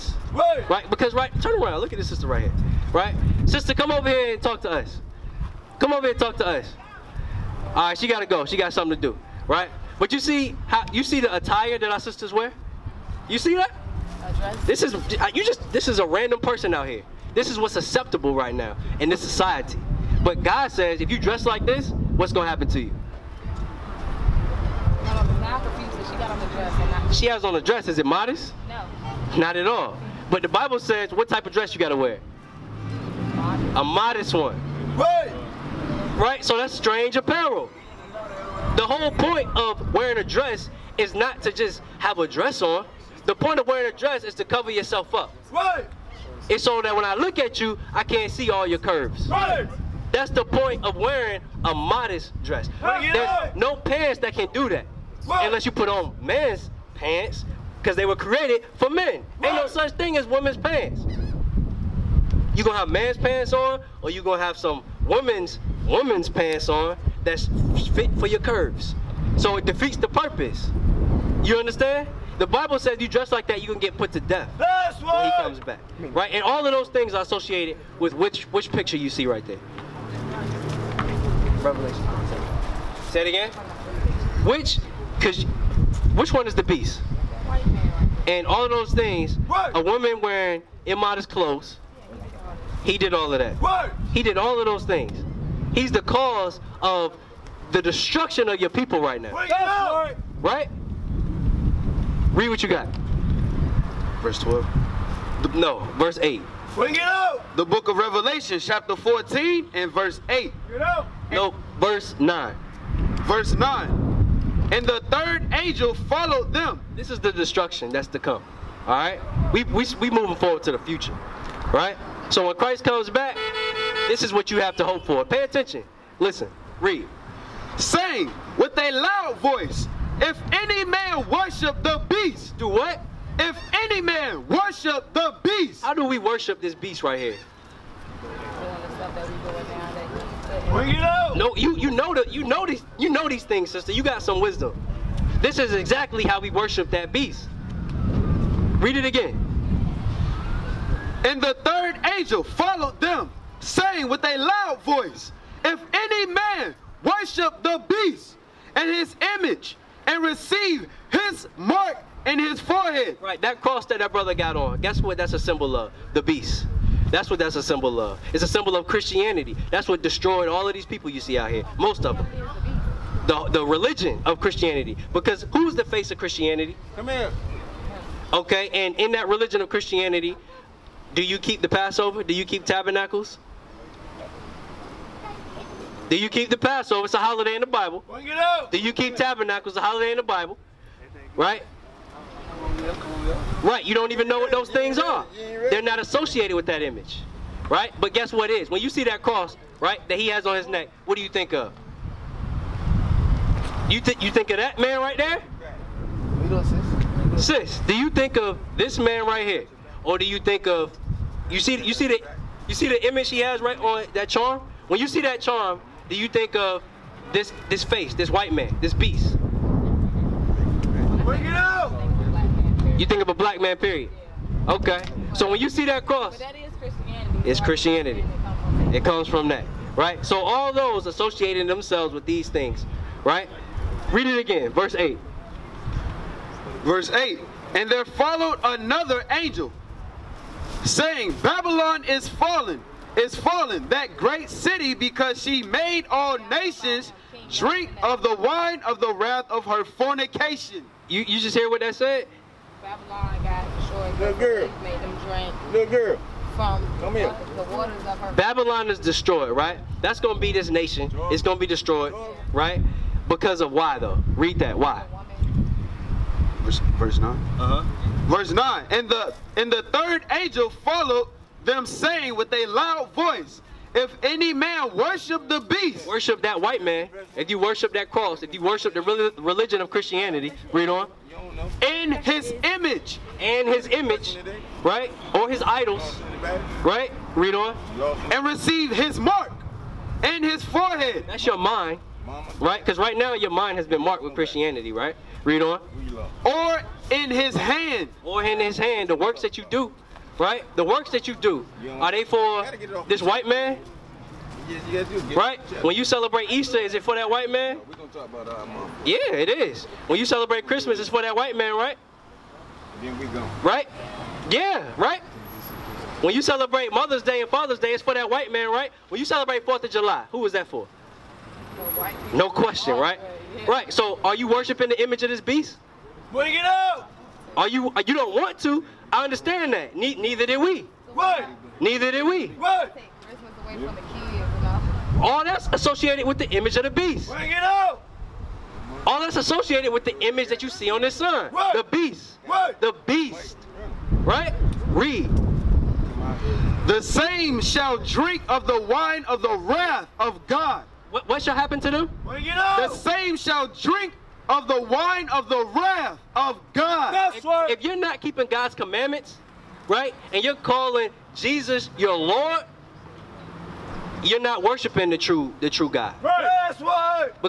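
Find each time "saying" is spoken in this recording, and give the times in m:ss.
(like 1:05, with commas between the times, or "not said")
2:07, 2:33, 4:00, 4:31.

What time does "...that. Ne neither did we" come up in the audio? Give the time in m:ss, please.
5:29.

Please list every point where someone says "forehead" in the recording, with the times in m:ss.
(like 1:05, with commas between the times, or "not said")
2:42, 4:50.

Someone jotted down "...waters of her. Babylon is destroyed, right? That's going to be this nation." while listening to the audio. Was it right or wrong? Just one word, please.
right.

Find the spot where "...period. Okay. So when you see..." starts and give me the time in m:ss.
3:43.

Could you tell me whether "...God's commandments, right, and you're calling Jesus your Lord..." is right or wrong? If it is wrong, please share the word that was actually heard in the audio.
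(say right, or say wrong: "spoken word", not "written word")
right.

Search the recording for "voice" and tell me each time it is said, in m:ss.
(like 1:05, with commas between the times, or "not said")
2:09, 2:34, 4:33.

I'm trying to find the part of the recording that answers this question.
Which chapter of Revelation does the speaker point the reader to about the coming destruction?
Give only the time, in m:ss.
1:48.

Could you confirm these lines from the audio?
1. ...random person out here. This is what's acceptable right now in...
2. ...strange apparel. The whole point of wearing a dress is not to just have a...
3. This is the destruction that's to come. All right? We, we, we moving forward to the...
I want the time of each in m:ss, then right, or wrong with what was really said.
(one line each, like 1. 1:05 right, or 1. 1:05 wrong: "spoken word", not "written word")
1. 0:16 right
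2. 0:36 right
3. 1:56 right.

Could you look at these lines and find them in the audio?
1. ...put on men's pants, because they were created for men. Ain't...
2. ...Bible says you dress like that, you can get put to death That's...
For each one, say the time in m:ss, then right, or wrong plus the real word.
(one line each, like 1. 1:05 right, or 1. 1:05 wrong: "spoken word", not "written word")
1. 0:55 right
2. 1:12 right.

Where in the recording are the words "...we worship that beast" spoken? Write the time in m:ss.
2:26.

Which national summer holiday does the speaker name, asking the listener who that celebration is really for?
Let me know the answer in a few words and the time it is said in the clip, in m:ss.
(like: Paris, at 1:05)
4th of July, at 5:19.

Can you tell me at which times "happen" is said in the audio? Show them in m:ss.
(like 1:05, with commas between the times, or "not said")
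0:22, 5:51.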